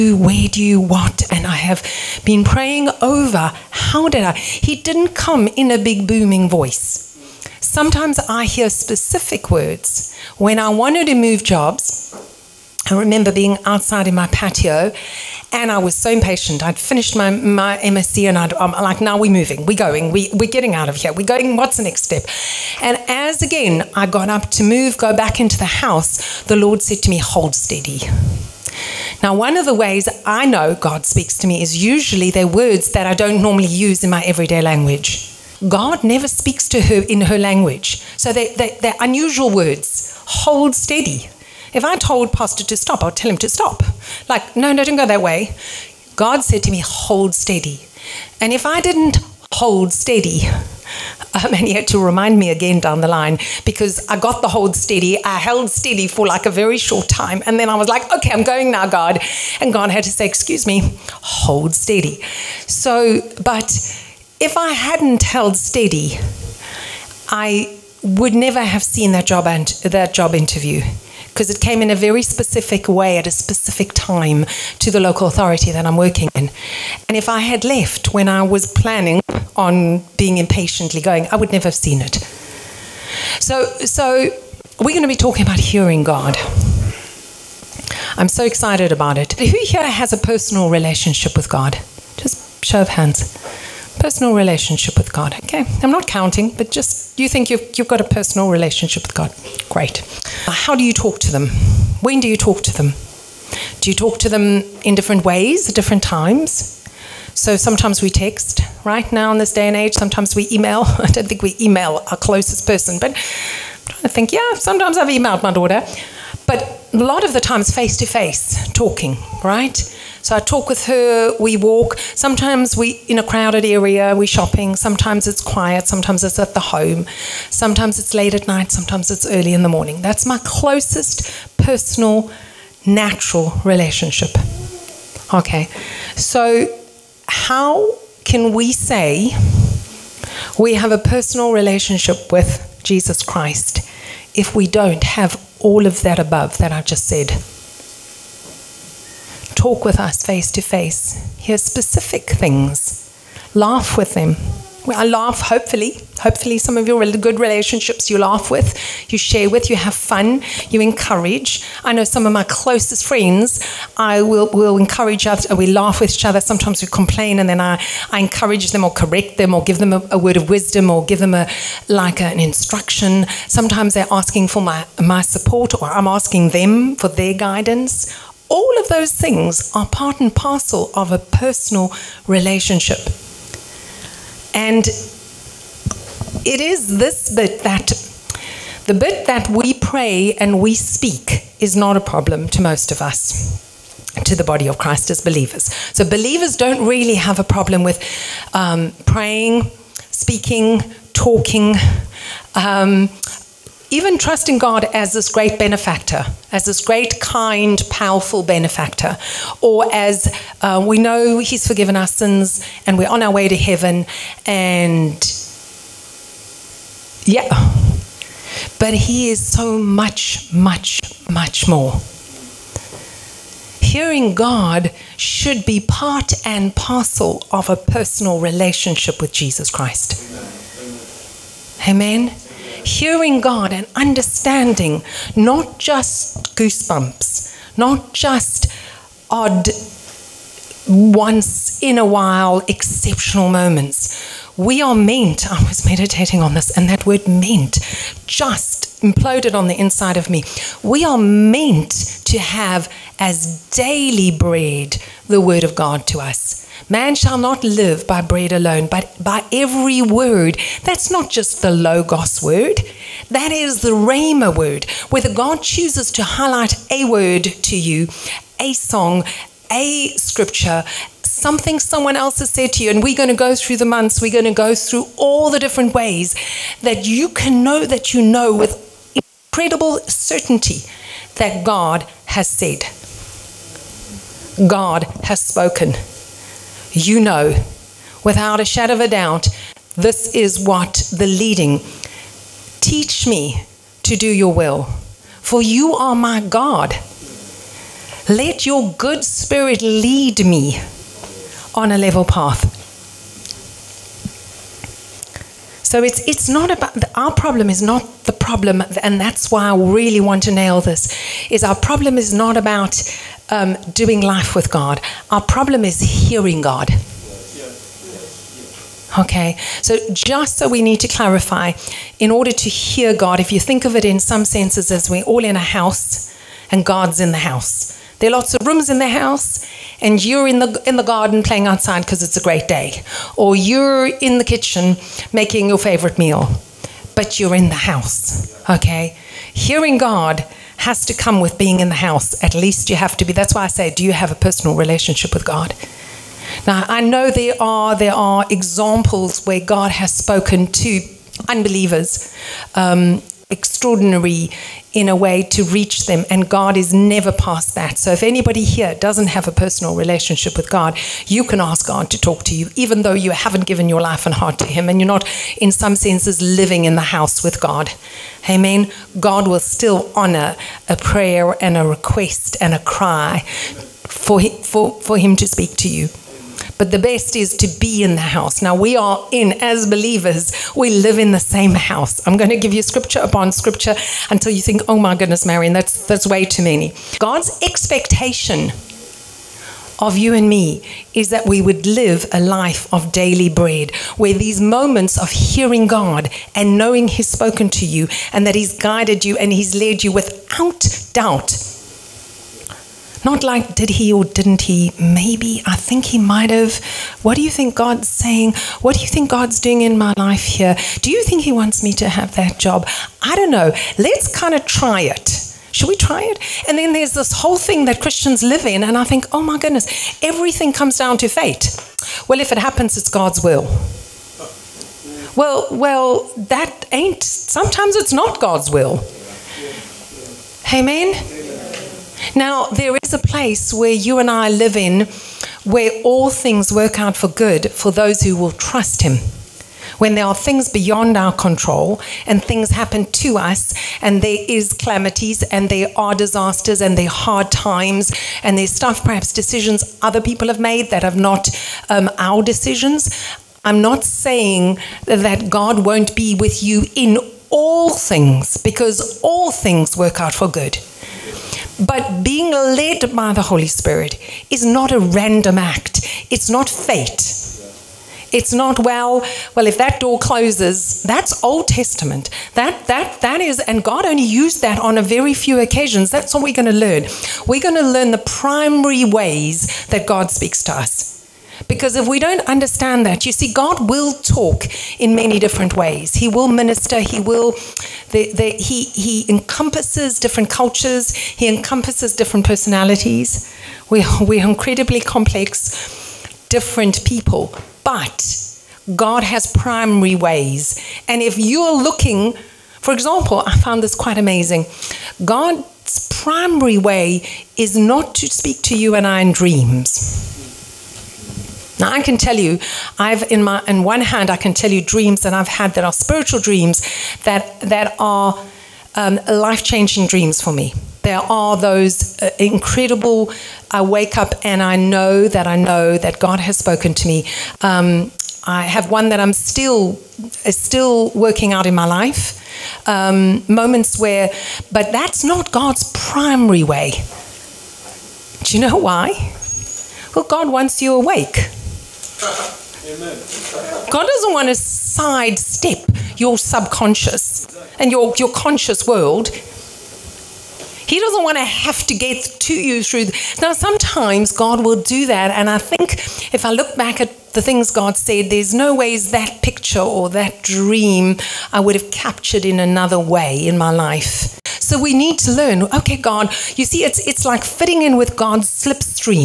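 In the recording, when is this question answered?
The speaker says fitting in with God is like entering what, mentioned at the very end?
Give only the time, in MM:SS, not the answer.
09:28.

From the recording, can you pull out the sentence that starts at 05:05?
So it's it's not about our problem is not the problem, and that's why I really want to nail this.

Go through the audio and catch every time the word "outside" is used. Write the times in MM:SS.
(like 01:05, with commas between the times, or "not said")
00:13, 05:31.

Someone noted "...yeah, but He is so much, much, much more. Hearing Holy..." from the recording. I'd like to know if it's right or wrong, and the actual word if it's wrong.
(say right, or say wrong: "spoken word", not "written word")
wrong: "God", not "Holy".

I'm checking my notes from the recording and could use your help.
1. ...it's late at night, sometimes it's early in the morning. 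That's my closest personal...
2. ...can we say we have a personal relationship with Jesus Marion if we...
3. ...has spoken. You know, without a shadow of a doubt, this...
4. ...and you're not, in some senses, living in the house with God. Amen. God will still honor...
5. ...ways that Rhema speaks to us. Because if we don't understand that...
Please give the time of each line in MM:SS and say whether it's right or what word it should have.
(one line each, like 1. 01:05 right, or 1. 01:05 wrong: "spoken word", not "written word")
1. 02:08 right
2. 02:18 wrong: "Christ", not "Marion"
3. 04:45 right
4. 06:04 right
5. 07:59 wrong: "God", not "Rhema".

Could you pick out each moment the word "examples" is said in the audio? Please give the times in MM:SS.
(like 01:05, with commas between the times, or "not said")
05:48, 08:22.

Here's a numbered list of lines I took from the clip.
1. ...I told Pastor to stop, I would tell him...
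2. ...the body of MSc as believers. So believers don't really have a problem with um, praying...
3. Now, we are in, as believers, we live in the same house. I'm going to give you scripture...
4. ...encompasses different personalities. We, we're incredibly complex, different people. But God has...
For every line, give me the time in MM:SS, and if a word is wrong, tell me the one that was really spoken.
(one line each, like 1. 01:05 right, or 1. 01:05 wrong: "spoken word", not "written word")
1. 00:41 right
2. 03:14 wrong: "Christ", not "MSc"
3. 06:18 right
4. 08:11 right.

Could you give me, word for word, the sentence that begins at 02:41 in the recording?
I know some of my closest friends, I will, will encourage us, we laugh with each other.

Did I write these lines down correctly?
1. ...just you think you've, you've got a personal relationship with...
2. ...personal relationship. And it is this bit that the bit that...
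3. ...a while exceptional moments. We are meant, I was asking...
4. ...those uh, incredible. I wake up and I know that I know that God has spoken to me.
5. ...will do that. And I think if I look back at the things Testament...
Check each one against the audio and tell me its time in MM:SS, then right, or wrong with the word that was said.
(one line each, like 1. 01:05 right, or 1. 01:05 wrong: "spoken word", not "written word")
1. 01:36 right
2. 03:01 right
3. 04:01 wrong: "meditating", not "asking"
4. 08:41 right
5. 09:14 wrong: "God", not "Testament".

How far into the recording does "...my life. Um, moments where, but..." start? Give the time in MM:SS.
08:51.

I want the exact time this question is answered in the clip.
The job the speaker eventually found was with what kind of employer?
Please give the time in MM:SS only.
01:14.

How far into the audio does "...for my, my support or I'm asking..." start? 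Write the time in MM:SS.
02:54.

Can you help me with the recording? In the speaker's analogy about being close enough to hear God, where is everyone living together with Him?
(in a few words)
A house.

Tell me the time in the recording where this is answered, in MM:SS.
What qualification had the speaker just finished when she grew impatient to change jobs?
00:17.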